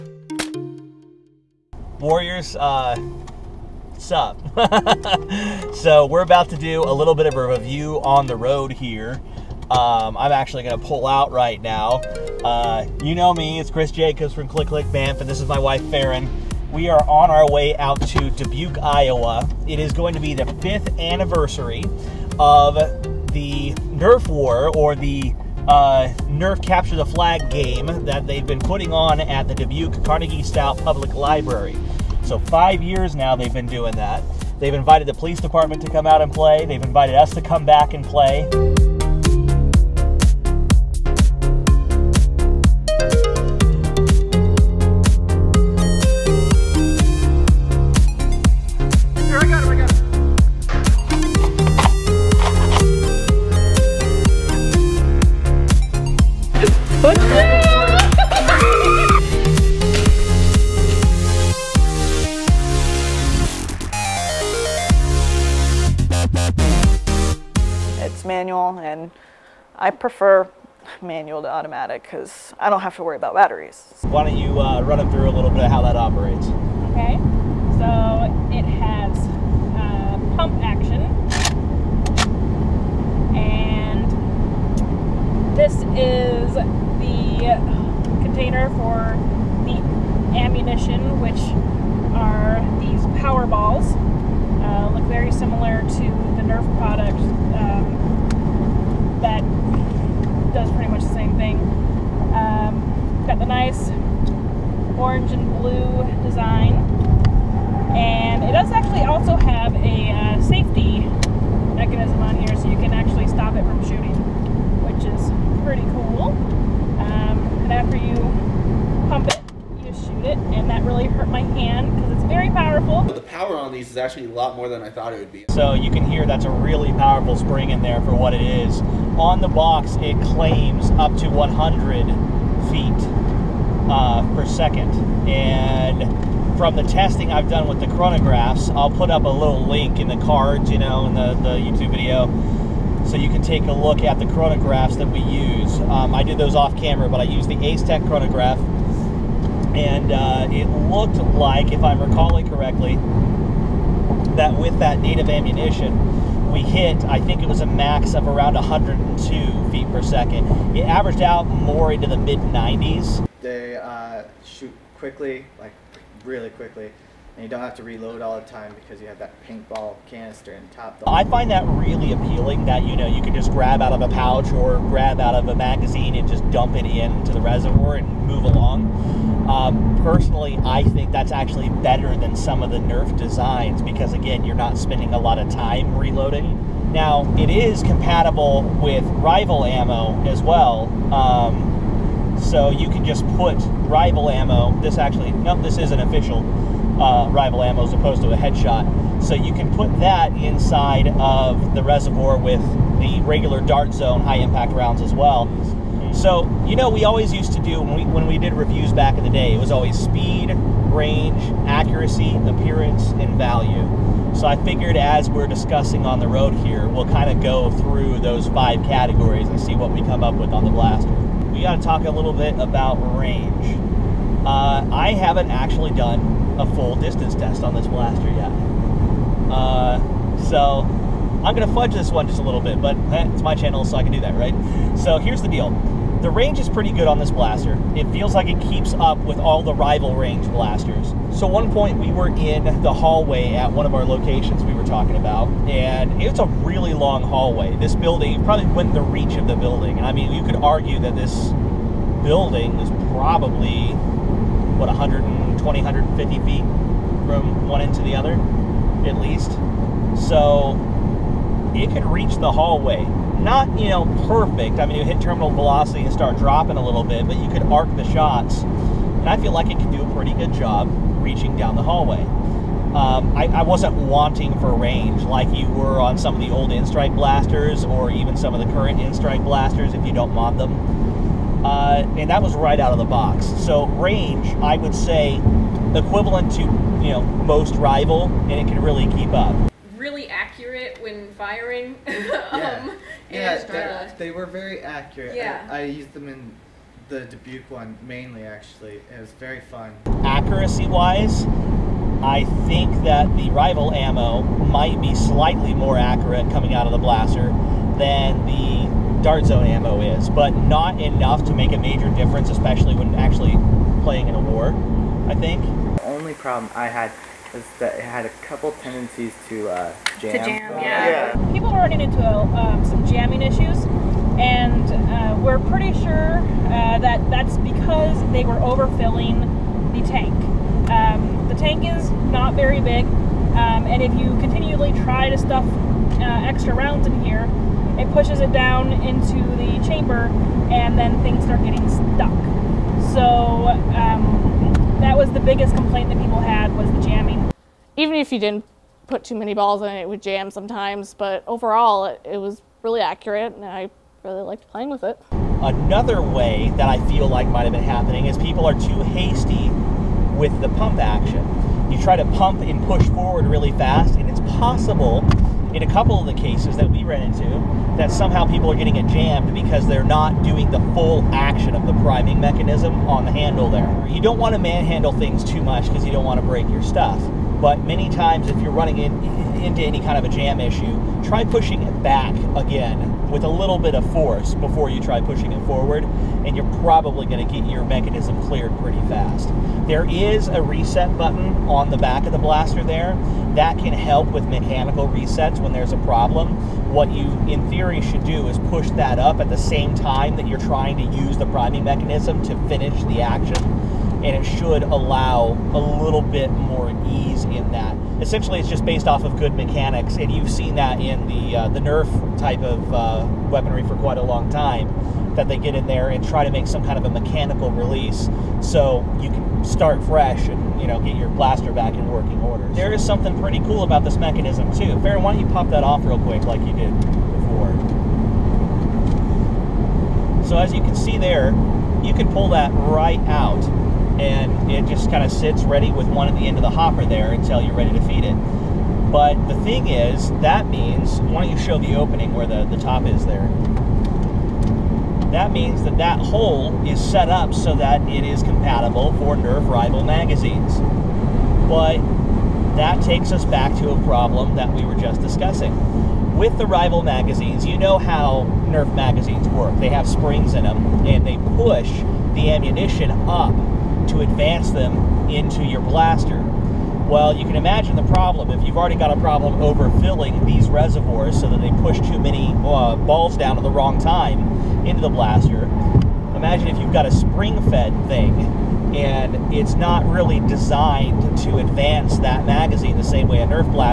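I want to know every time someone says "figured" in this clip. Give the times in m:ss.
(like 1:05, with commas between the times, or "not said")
3:34.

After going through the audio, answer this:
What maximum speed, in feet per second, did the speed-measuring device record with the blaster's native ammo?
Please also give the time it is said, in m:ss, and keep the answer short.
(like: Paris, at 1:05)
102, at 2:38.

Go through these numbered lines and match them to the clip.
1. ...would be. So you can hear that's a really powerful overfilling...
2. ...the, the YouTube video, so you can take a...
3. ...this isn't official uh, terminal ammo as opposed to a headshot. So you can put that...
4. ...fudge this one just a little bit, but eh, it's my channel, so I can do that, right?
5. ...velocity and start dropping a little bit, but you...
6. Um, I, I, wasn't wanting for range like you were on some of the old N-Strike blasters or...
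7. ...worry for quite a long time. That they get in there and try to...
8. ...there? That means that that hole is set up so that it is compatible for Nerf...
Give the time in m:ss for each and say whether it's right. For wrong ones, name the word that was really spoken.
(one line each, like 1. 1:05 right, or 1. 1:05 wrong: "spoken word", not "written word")
1. 2:05 wrong: "spring", not "overfilling"
2. 2:21 right
3. 3:15 wrong: "rival", not "terminal"
4. 3:51 right
5. 4:25 right
6. 4:32 right
7. 6:53 wrong: "weaponry", not "worry"
8. 7:23 right.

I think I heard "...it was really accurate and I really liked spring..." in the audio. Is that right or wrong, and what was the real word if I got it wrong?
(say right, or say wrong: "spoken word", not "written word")
wrong: "playing", not "spring".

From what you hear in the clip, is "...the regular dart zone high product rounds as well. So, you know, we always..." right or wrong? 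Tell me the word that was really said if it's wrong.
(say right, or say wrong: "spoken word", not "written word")
wrong: "impact", not "product".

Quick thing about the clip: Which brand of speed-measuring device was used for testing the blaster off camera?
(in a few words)
Ace Tech.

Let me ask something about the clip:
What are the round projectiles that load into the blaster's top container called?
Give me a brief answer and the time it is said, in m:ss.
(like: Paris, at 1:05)
power balls, at 1:33.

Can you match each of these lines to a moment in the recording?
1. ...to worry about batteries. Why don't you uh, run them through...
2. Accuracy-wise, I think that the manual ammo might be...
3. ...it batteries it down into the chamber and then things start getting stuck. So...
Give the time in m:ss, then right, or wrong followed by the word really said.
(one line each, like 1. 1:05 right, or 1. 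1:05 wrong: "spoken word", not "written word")
1. 1:12 right
2. 5:00 wrong: "rival", not "manual"
3. 5:37 wrong: "pushes", not "batteries".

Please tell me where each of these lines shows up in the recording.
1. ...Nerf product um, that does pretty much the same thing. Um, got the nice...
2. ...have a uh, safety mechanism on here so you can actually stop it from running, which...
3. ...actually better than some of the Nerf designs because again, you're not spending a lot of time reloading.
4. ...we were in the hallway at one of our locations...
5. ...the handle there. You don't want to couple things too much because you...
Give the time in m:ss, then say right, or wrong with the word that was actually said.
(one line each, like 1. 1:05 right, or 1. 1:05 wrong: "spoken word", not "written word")
1. 1:36 right
2. 1:49 wrong: "shooting", not "running"
3. 3:01 right
4. 4:01 right
5. 6:13 wrong: "manhandle", not "couple".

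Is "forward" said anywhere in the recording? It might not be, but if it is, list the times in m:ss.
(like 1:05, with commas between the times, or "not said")
6:03, 6:25.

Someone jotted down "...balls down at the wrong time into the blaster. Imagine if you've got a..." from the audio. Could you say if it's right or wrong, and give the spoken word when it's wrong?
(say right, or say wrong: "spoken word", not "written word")
right.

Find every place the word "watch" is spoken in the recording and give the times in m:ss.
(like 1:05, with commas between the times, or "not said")
not said.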